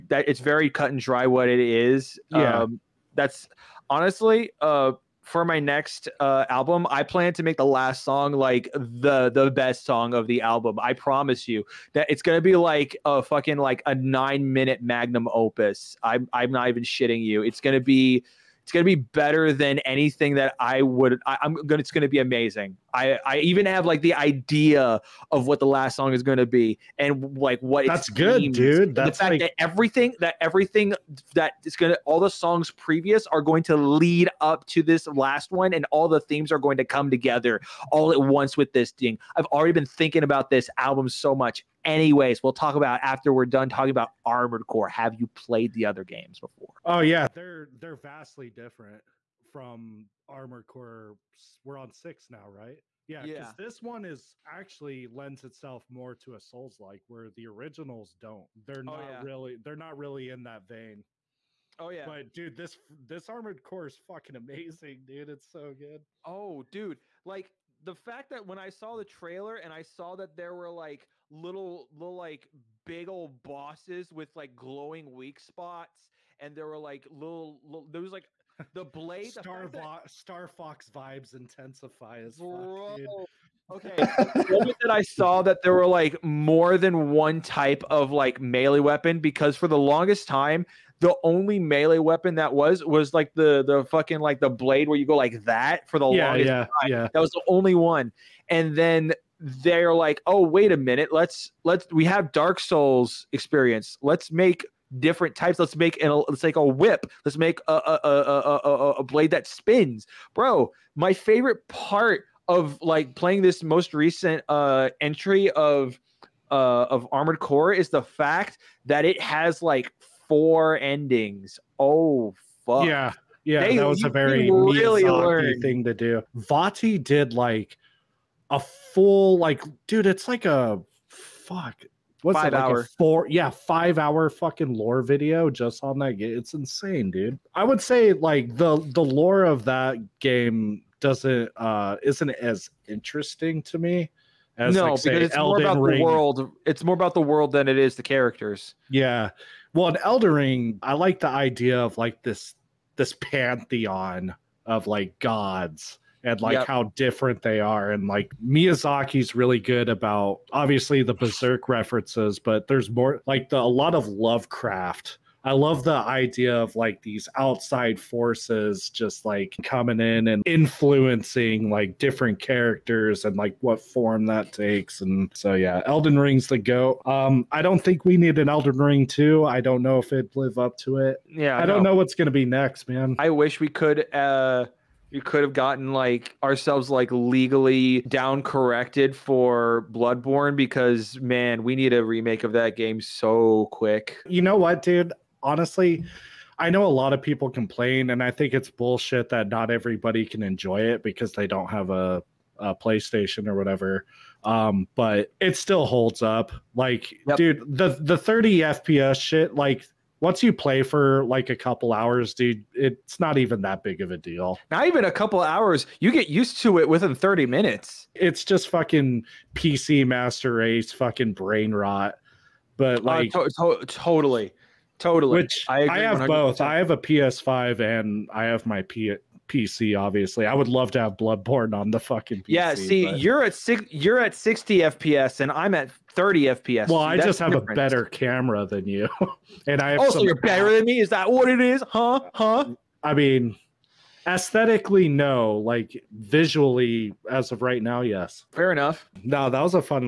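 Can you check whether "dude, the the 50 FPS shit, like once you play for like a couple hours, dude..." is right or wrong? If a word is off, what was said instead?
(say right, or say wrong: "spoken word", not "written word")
wrong: "30", not "50".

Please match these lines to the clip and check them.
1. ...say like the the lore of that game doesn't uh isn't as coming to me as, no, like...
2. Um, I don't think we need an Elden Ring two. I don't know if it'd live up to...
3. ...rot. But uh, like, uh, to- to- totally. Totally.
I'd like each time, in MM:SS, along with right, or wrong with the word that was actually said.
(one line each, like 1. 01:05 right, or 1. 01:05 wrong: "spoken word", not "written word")
1. 02:17 wrong: "interesting", not "coming"
2. 02:57 right
3. 03:41 right.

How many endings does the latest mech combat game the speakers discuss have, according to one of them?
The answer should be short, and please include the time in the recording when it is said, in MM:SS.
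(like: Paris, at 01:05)
4, at 02:00.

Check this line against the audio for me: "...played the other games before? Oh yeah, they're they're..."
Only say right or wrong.
right.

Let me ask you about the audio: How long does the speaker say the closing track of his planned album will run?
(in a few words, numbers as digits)
9 minutes.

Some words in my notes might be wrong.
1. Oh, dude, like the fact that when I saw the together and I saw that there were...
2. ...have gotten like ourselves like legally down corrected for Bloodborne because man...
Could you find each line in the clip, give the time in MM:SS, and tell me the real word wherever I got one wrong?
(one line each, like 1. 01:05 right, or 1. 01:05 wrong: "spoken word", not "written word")
1. 01:06 wrong: "trailer", not "together"
2. 03:05 right.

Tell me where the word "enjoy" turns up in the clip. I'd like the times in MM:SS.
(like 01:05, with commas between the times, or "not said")
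03:20.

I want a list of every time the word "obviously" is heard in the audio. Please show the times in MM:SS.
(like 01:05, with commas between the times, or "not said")
02:40, 03:49.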